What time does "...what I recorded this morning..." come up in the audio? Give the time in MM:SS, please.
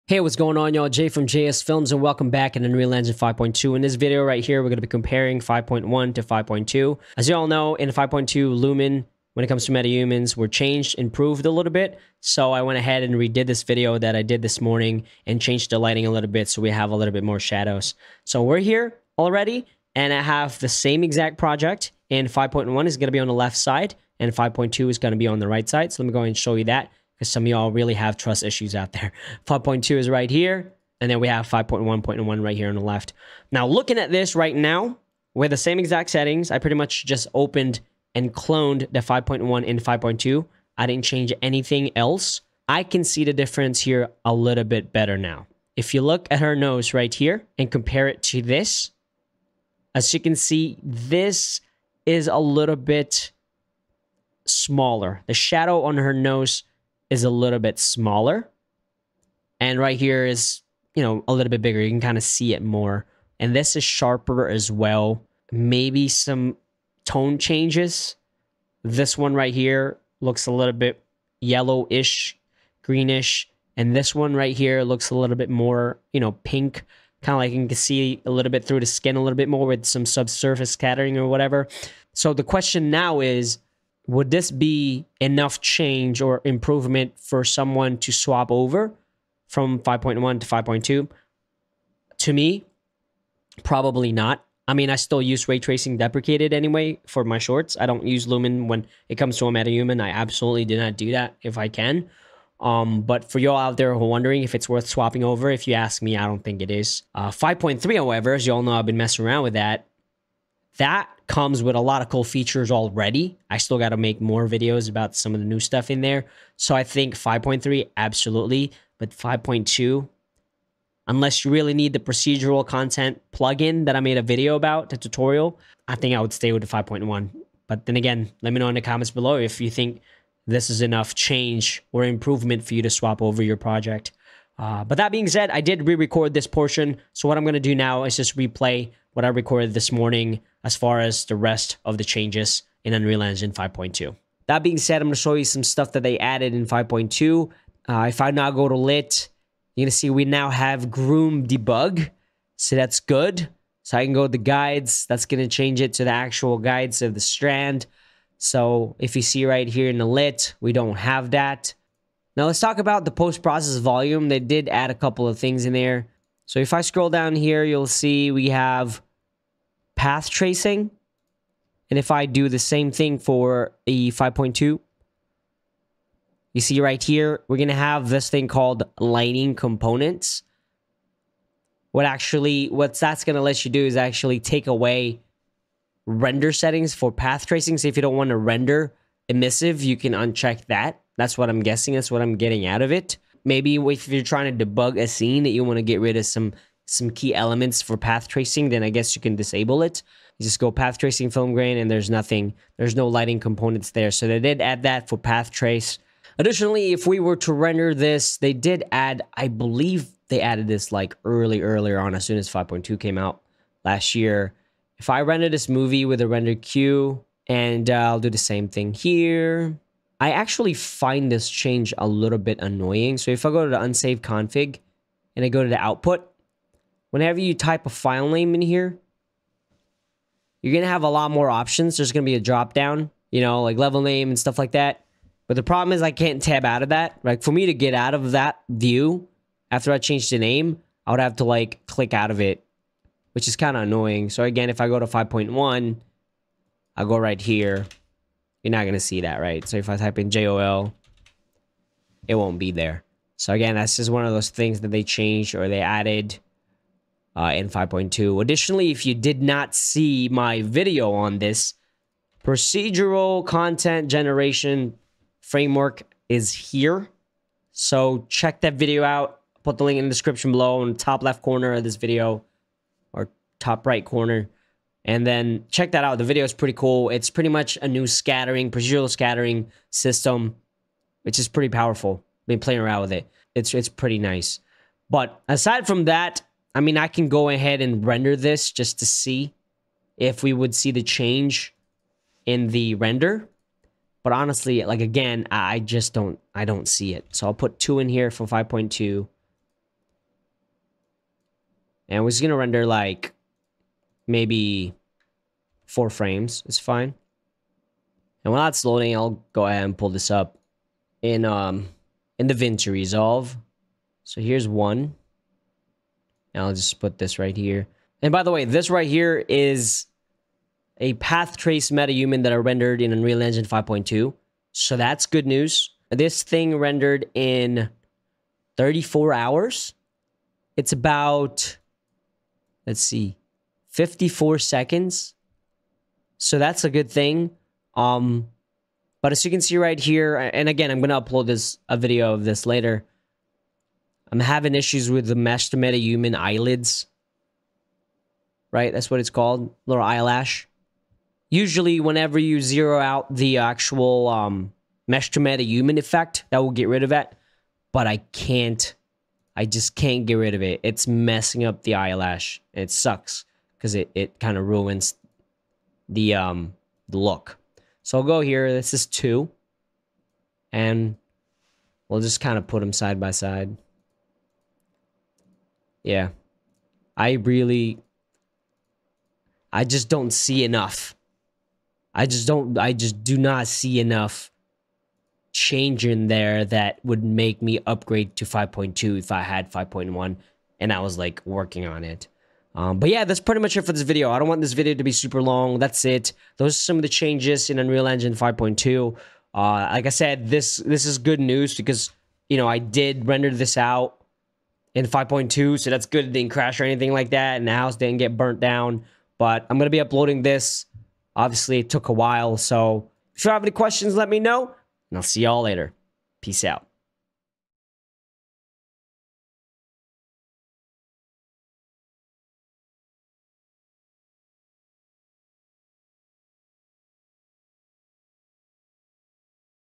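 02:19.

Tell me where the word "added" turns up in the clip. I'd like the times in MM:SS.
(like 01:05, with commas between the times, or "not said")
02:26, 03:30, 04:15.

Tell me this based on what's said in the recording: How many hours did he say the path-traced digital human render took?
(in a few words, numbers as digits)
34.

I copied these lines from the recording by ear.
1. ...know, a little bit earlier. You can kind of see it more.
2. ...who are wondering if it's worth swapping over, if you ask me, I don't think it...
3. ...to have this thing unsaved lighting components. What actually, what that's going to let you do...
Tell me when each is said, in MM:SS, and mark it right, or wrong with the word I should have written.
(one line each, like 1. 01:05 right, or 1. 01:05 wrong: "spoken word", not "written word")
1. 01:01 wrong: "bigger", not "earlier"
2. 01:43 right
3. 02:57 wrong: "called", not "unsaved".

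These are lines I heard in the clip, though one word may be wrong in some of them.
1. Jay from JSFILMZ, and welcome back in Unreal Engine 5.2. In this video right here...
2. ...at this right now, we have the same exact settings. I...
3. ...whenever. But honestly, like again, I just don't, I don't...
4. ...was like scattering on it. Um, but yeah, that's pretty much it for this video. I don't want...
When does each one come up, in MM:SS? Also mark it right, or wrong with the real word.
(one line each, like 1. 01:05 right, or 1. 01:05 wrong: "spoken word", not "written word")
1. 00:00 right
2. 00:33 right
3. 04:52 wrong: "render", not "whenever"
4. 06:30 wrong: "working", not "scattering".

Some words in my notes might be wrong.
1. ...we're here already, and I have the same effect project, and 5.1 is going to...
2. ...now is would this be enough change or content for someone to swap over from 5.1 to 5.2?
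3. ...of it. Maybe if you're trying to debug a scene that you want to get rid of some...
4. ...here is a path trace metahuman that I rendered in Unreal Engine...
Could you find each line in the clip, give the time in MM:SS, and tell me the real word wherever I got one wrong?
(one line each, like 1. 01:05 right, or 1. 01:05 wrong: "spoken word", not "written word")
1. 00:18 wrong: "exact", not "effect"
2. 01:22 wrong: "improvement", not "content"
3. 03:12 right
4. 05:19 right.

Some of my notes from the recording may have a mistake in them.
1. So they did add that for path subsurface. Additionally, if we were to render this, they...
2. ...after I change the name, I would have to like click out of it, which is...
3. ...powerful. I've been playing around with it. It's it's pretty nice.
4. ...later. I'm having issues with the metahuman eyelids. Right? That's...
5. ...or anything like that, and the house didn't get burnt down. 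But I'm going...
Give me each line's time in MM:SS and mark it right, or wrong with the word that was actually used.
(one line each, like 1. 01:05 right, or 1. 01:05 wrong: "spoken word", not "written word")
1. 03:24 wrong: "trace", not "subsurface"
2. 03:59 right
3. 04:41 right
4. 05:42 right
5. 06:46 right.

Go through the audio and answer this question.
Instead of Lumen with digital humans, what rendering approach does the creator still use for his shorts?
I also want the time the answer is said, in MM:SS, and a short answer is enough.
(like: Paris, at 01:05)
ray tracing deprecated, at 01:35.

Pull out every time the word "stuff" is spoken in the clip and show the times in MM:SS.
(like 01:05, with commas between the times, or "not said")
01:55, 02:25, 03:54.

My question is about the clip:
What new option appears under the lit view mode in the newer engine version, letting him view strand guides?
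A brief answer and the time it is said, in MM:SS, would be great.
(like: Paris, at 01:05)
groom debug, at 02:30.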